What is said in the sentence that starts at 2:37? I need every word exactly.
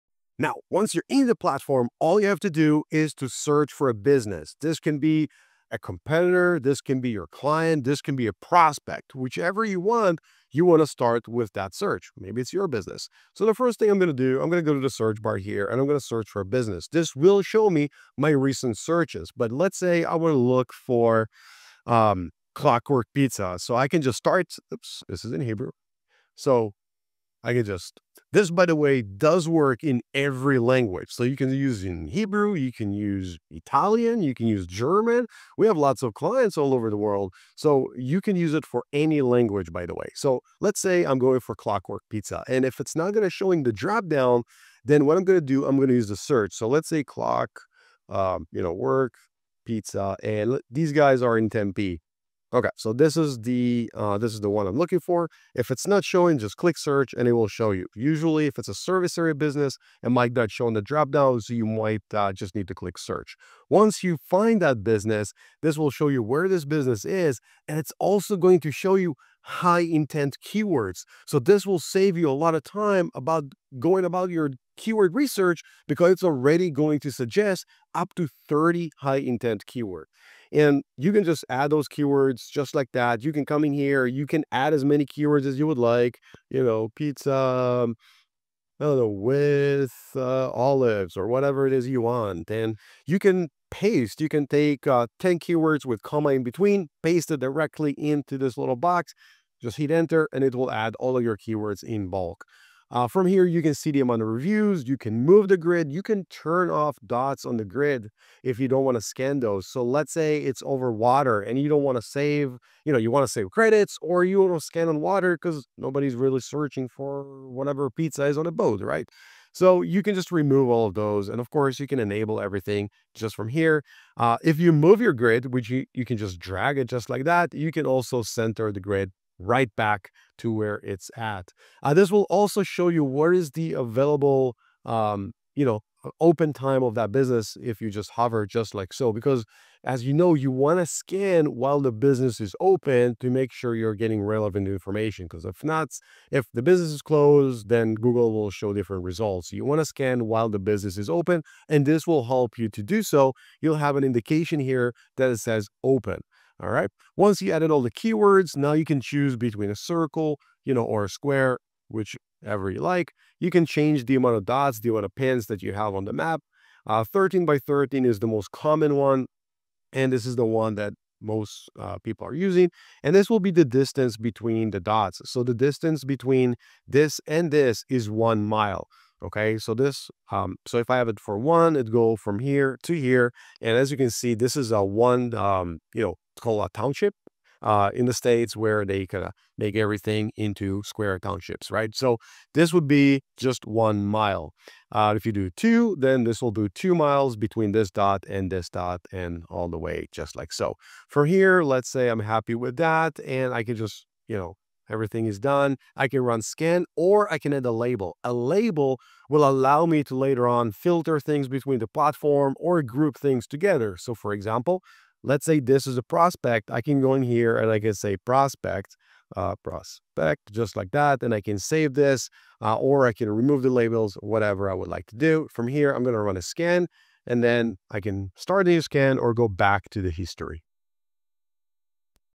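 Once you added all the keywords, now you can choose between a circle, you know, or a square, whichever you like.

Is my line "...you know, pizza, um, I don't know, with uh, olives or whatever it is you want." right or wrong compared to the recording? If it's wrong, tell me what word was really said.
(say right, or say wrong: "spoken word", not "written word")
right.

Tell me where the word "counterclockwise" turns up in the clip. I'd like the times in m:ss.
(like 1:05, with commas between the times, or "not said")
not said.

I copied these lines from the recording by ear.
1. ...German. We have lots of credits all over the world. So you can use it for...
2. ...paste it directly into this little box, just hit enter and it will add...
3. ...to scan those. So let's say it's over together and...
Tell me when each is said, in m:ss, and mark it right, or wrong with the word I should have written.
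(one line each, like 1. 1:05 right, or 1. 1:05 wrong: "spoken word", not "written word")
1. 0:34 wrong: "clients", not "credits"
2. 1:37 right
3. 1:48 wrong: "water", not "together".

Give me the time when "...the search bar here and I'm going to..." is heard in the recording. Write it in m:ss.
0:14.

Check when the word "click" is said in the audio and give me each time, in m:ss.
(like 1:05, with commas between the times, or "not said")
0:56, 1:02.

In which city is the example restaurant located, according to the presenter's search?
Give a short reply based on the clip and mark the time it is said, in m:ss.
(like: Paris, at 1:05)
Tempe, at 0:51.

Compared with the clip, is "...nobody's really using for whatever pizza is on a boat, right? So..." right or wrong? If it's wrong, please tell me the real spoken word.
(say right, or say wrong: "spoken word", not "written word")
wrong: "searching", not "using".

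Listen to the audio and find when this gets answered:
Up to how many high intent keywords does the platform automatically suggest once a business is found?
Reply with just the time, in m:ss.
1:18.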